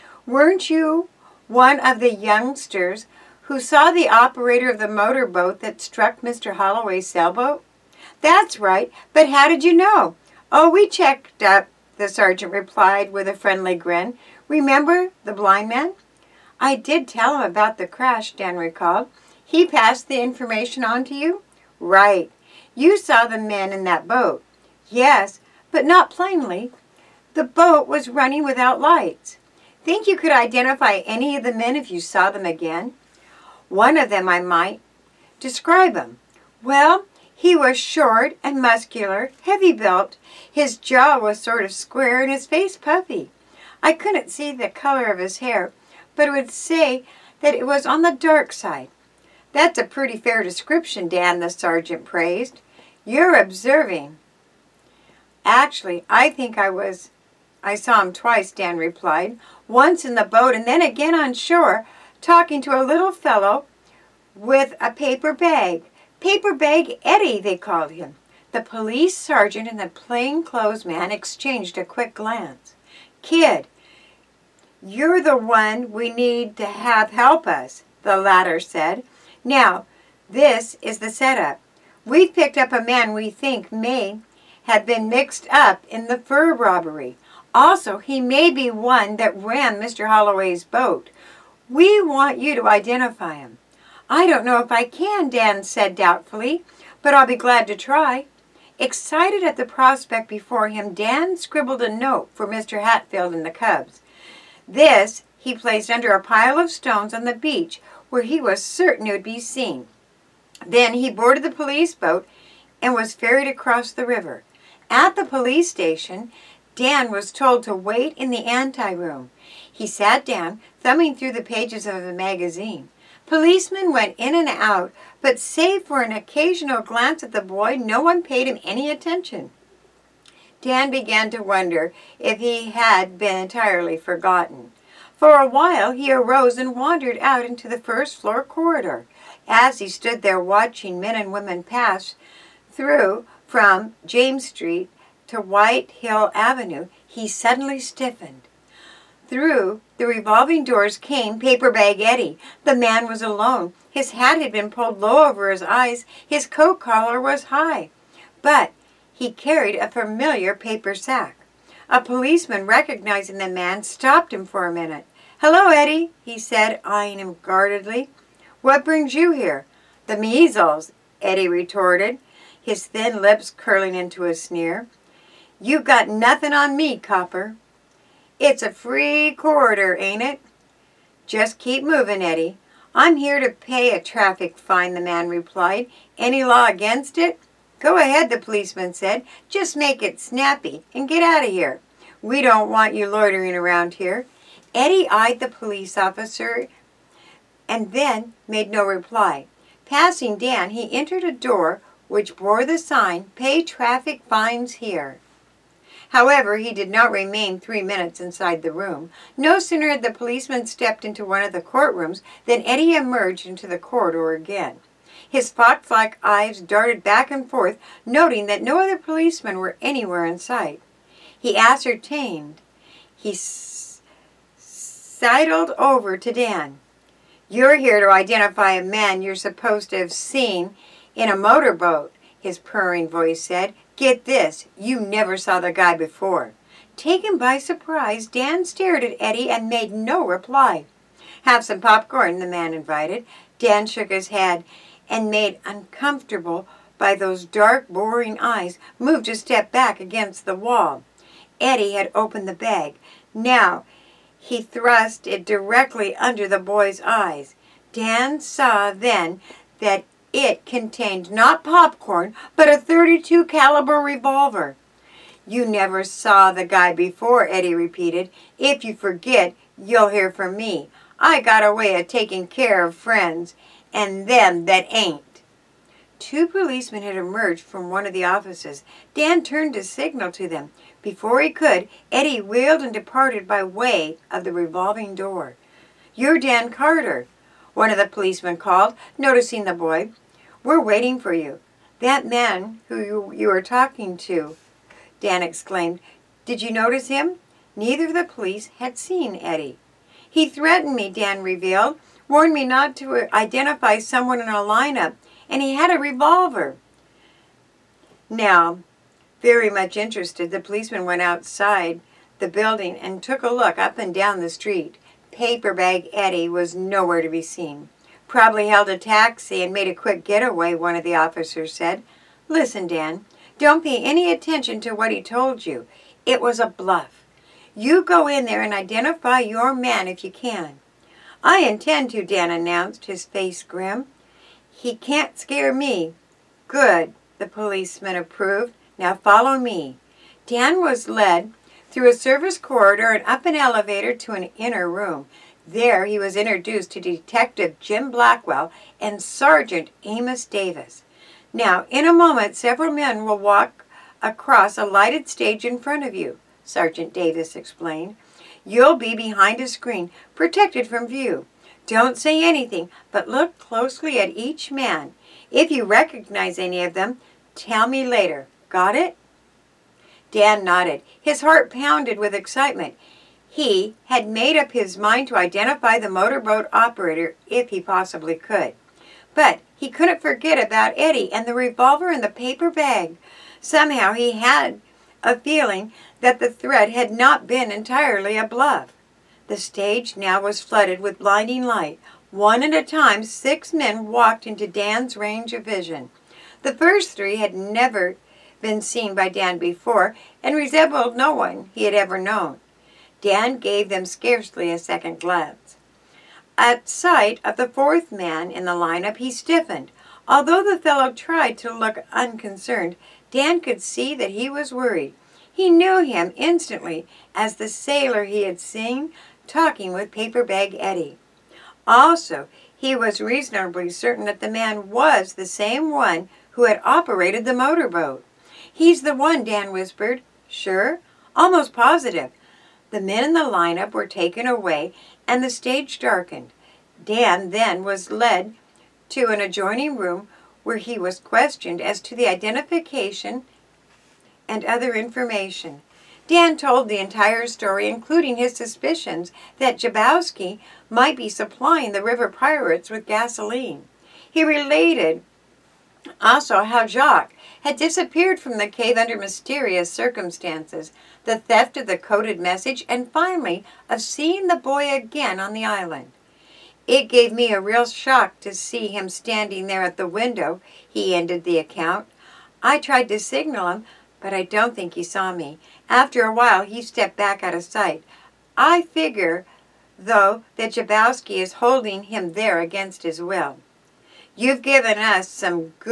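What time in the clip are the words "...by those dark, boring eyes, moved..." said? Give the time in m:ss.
4:06.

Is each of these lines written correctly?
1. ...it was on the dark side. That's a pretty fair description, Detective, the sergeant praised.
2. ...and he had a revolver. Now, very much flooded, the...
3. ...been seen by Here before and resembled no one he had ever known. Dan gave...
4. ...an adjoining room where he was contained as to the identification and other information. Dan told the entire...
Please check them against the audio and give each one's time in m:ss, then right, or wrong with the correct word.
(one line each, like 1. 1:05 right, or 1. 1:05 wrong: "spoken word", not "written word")
1. 0:47 wrong: "Dan", not "Detective"
2. 5:05 wrong: "interested", not "flooded"
3. 6:38 wrong: "Dan", not "Here"
4. 7:19 wrong: "questioned", not "contained".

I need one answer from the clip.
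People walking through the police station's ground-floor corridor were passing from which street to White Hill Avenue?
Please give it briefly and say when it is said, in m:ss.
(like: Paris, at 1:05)
James Street, at 2:24.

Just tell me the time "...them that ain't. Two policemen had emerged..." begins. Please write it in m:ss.
4:34.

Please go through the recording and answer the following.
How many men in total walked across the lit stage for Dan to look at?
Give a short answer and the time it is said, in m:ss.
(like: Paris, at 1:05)
6, at 6:33.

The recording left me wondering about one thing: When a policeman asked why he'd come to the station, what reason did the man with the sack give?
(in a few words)
To pay a traffic fine.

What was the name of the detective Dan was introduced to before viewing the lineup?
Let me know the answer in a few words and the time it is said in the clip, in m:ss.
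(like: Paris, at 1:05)
Jim Blackwell, at 5:47.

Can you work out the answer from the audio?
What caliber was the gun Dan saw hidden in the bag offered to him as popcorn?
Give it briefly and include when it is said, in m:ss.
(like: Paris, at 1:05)
32, at 4:22.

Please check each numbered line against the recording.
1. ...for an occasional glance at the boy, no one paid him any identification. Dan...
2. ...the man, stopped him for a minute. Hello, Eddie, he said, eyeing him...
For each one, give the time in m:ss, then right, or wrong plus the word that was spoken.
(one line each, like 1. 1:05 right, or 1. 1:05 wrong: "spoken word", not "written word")
1. 2:05 wrong: "attention", not "identification"
2. 2:43 right.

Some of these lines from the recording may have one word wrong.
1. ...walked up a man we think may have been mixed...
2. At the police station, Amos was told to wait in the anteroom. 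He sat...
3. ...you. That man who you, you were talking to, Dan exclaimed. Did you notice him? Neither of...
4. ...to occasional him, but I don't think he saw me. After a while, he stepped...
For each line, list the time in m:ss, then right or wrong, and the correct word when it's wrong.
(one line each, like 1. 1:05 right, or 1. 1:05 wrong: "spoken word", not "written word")
1. 1:22 wrong: "picked", not "walked"
2. 1:54 wrong: "Dan", not "Amos"
3. 4:51 right
4. 7:53 wrong: "signal", not "occasional".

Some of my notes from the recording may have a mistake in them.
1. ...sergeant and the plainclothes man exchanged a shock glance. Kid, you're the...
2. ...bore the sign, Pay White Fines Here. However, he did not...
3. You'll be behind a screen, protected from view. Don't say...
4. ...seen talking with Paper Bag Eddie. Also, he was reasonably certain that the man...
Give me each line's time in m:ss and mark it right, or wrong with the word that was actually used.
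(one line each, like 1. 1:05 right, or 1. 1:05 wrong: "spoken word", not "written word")
1. 1:09 wrong: "quick", not "shock"
2. 3:22 wrong: "Traffic", not "White"
3. 5:58 right
4. 6:58 right.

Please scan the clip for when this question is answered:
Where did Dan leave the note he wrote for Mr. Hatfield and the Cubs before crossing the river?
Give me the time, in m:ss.
1:45.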